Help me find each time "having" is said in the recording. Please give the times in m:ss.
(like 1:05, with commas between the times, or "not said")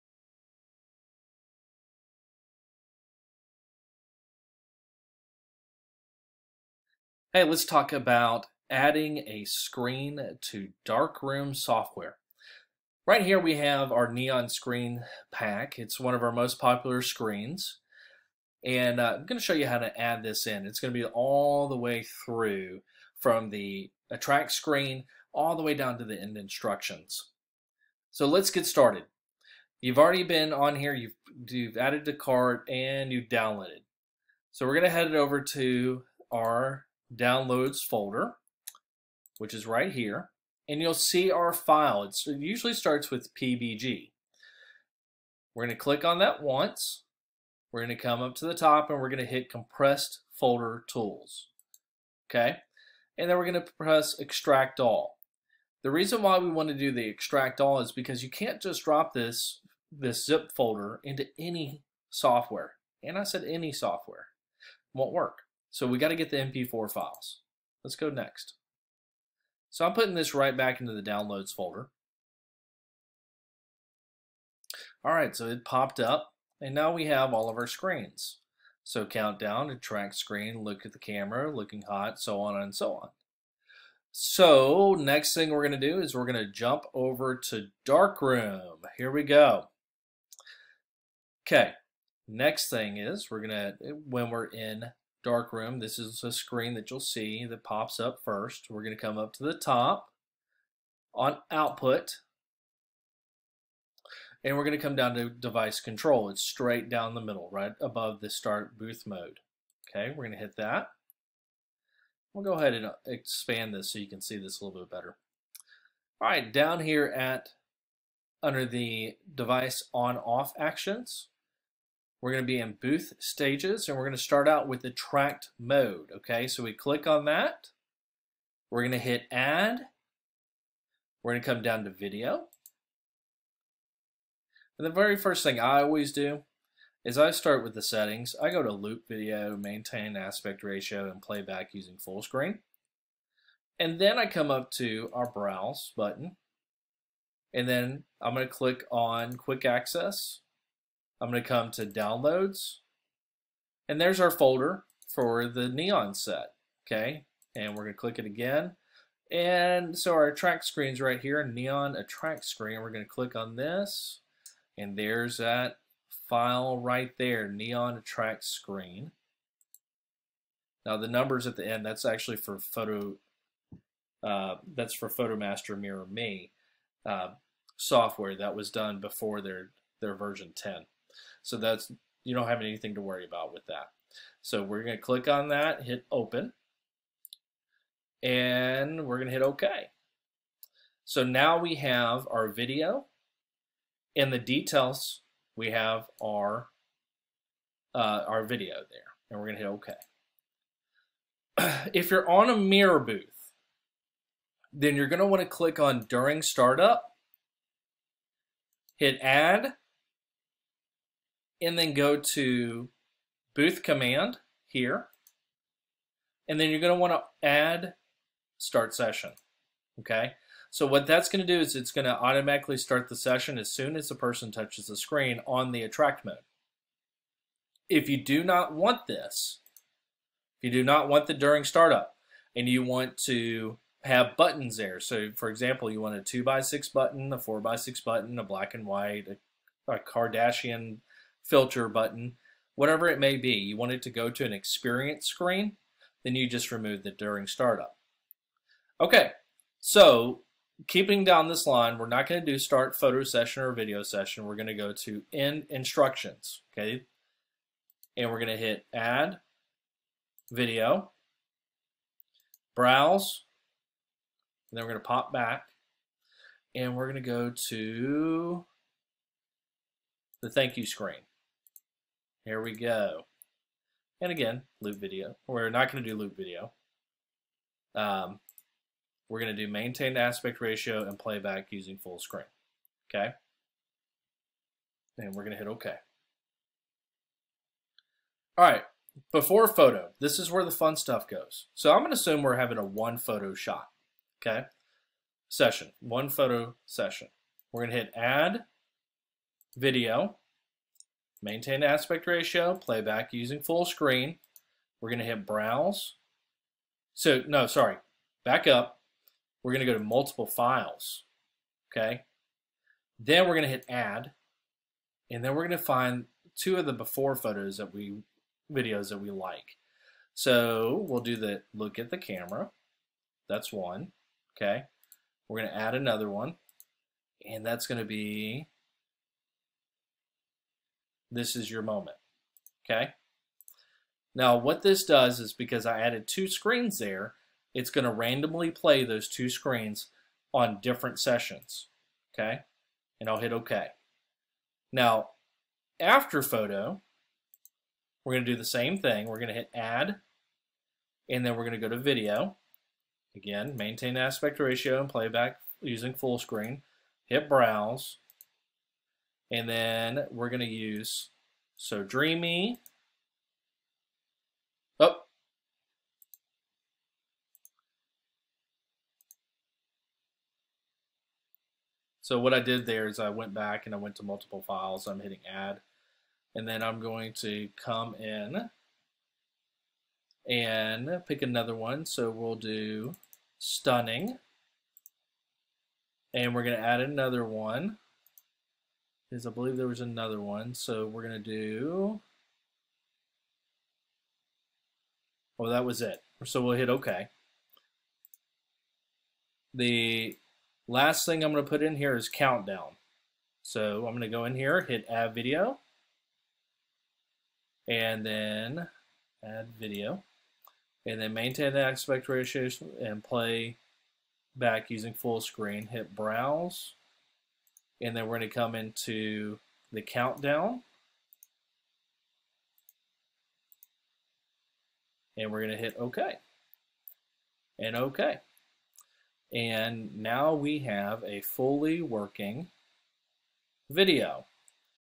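4:52.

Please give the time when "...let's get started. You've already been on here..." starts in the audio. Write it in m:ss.
0:28.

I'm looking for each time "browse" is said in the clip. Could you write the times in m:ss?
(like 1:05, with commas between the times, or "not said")
2:25, 4:22, 5:05, 5:57, 6:56.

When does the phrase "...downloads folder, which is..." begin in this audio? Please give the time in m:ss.
0:37.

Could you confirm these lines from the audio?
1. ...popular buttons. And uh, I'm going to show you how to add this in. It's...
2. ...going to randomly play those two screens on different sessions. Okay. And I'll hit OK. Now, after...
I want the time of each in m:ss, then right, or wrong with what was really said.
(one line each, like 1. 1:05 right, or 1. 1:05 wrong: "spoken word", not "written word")
1. 0:16 wrong: "screens", not "buttons"
2. 5:37 right.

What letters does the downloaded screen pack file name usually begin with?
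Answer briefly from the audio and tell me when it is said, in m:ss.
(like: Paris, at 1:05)
PBG, at 0:43.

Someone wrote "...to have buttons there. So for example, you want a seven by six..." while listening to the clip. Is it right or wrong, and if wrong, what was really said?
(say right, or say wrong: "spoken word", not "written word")
wrong: "two", not "seven".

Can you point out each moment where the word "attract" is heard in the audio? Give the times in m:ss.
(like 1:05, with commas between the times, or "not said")
0:24, 2:41, 2:47, 3:45.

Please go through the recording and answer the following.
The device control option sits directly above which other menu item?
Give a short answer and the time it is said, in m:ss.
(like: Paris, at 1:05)
start booth mode, at 1:48.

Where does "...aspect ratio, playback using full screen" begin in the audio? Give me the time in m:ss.
5:01.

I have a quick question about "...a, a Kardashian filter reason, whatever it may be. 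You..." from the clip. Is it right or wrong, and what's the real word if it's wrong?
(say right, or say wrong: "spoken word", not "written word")
wrong: "button", not "reason".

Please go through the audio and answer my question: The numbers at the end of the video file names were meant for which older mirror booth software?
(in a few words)
Fotomaster Mirror Me.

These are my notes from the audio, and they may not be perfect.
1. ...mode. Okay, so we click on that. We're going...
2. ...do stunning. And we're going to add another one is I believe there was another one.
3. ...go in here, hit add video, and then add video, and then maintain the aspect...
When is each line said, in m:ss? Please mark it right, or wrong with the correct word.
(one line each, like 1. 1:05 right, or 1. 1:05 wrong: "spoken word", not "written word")
1. 2:05 right
2. 6:22 right
3. 6:44 right.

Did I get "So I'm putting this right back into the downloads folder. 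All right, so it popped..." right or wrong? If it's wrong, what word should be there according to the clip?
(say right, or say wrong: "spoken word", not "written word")
right.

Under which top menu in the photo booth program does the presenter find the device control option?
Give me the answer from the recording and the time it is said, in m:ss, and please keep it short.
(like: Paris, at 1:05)
output, at 1:41.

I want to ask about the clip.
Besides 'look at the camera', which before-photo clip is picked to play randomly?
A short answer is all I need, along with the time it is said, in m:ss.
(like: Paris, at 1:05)
this is your moment, at 5:31.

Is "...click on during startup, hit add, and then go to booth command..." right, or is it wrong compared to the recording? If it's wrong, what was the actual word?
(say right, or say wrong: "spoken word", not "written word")
right.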